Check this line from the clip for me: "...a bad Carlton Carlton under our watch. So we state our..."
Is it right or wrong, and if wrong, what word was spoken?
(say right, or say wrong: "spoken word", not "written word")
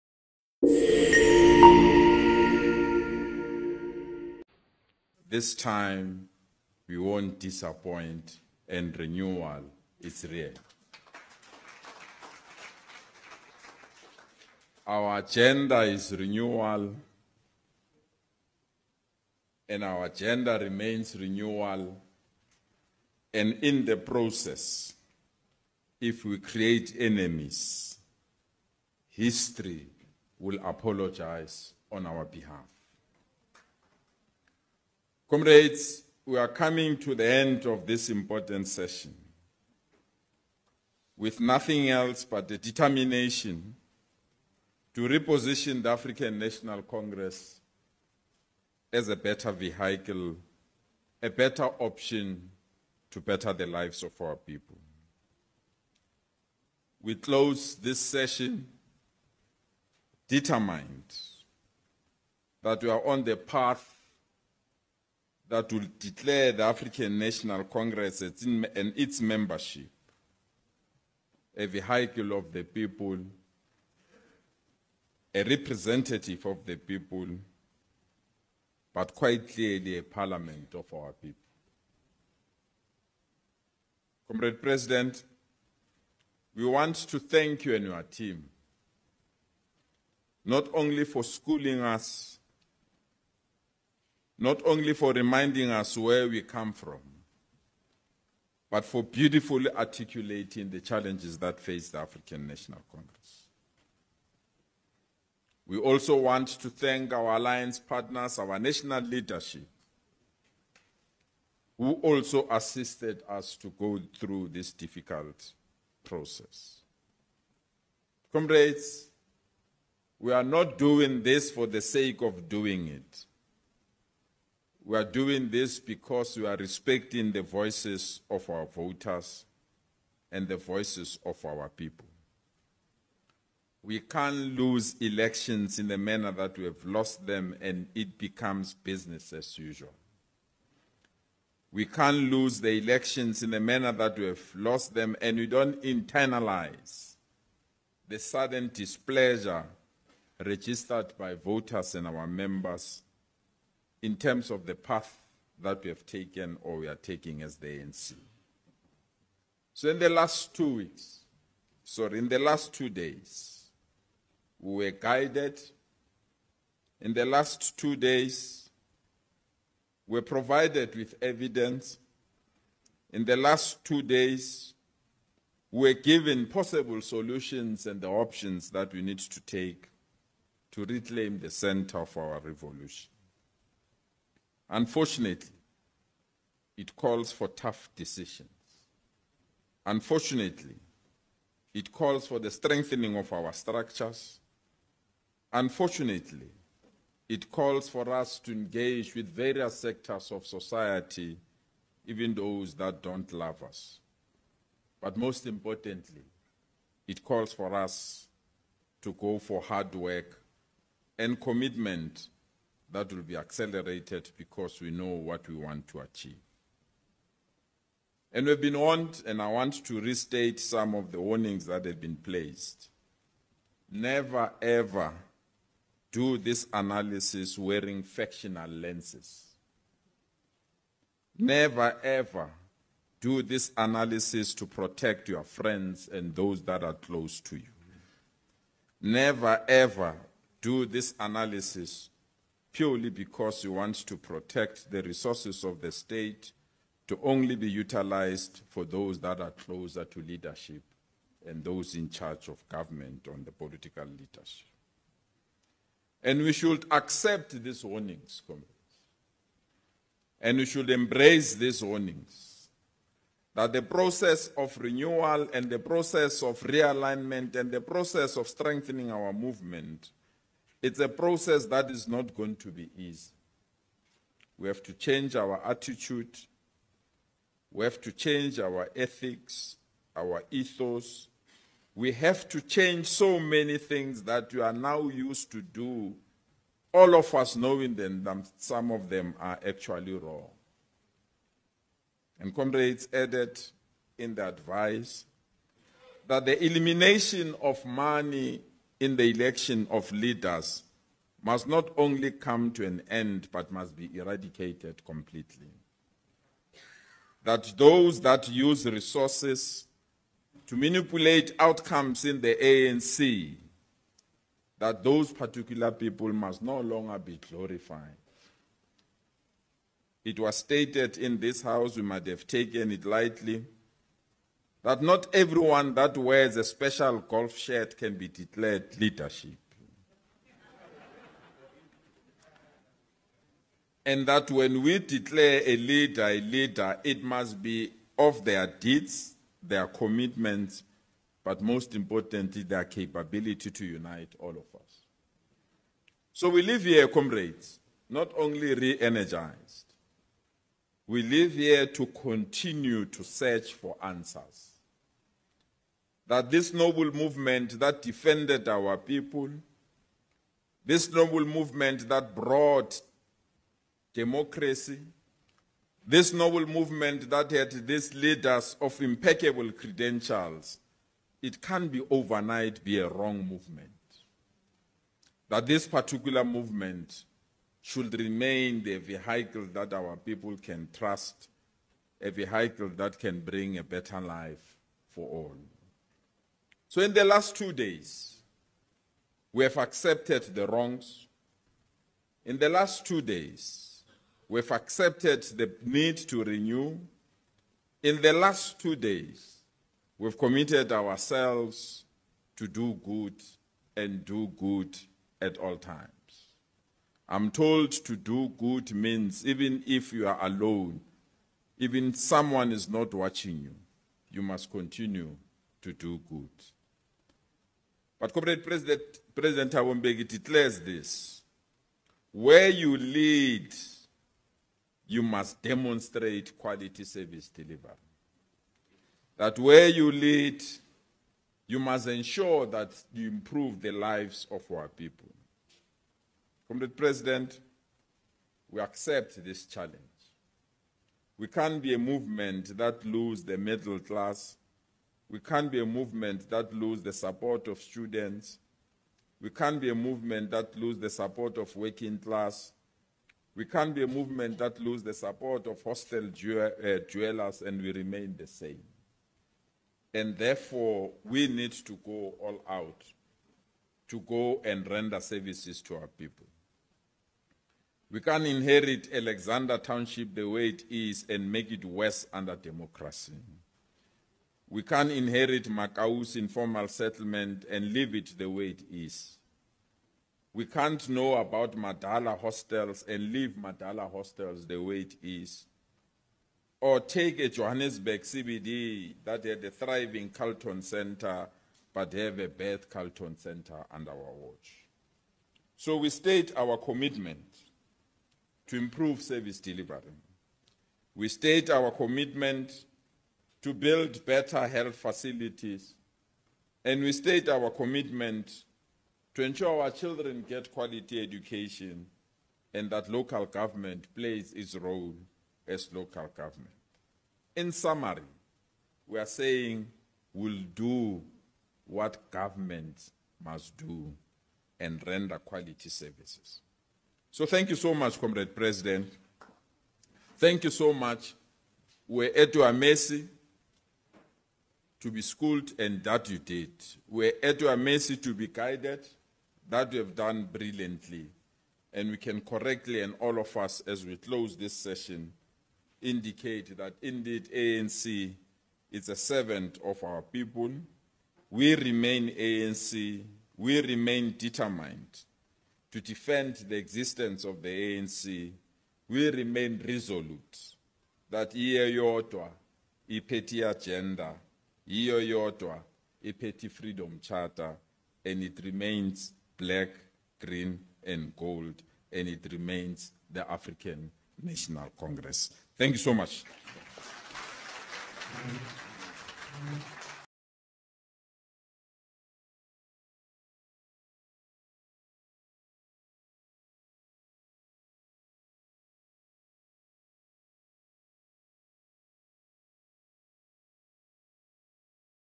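wrong: "Center", not "Carlton".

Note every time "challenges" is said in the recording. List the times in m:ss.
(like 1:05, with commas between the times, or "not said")
1:40, 7:19.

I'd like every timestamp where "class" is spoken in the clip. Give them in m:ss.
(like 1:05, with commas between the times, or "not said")
7:23, 7:32.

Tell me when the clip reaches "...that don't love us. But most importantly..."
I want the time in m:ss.
3:22.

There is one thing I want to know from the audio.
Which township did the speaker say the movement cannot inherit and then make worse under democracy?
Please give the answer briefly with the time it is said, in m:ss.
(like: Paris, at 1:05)
Alexandra Township, at 7:49.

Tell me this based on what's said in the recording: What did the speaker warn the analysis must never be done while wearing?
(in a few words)
Factional lenses.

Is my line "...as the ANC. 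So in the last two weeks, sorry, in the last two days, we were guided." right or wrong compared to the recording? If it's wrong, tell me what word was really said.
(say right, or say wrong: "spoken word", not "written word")
right.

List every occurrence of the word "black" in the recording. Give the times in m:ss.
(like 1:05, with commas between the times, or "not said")
9:29.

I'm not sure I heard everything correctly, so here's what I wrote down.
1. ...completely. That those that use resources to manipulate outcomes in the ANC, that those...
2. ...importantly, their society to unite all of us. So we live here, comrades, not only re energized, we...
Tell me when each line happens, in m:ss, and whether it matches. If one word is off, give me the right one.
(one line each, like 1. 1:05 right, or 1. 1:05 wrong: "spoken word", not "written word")
1. 5:05 right
2. 5:41 wrong: "capability", not "society".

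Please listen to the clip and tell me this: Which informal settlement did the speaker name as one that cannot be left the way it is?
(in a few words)
Makause.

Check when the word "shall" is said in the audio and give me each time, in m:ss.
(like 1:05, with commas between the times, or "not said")
not said.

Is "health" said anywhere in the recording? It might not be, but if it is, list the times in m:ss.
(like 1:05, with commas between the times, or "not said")
8:24.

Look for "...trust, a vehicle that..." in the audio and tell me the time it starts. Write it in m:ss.
6:20.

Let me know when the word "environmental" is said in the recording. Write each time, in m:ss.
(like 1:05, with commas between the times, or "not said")
not said.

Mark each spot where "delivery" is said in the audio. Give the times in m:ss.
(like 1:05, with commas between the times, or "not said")
7:07, 8:19.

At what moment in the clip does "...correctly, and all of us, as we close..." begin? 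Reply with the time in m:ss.
9:02.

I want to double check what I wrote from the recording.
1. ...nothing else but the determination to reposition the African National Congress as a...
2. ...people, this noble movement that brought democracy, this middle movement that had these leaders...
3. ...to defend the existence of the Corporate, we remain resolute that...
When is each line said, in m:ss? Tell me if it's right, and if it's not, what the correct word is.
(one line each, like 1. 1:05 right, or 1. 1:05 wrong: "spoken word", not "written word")
1. 0:41 right
2. 5:58 wrong: "noble", not "middle"
3. 9:15 wrong: "ANC", not "Corporate".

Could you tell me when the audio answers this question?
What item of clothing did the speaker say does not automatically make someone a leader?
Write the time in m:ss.
5:26.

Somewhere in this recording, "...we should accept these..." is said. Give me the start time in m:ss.
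4:16.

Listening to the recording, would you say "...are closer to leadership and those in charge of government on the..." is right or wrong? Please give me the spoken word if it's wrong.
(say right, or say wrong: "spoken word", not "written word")
right.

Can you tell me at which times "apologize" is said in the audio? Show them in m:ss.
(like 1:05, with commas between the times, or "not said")
0:30.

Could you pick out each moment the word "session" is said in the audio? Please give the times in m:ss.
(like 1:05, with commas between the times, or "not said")
0:38, 0:58, 9:04.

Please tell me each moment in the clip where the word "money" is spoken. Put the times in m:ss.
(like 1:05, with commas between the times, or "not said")
4:57.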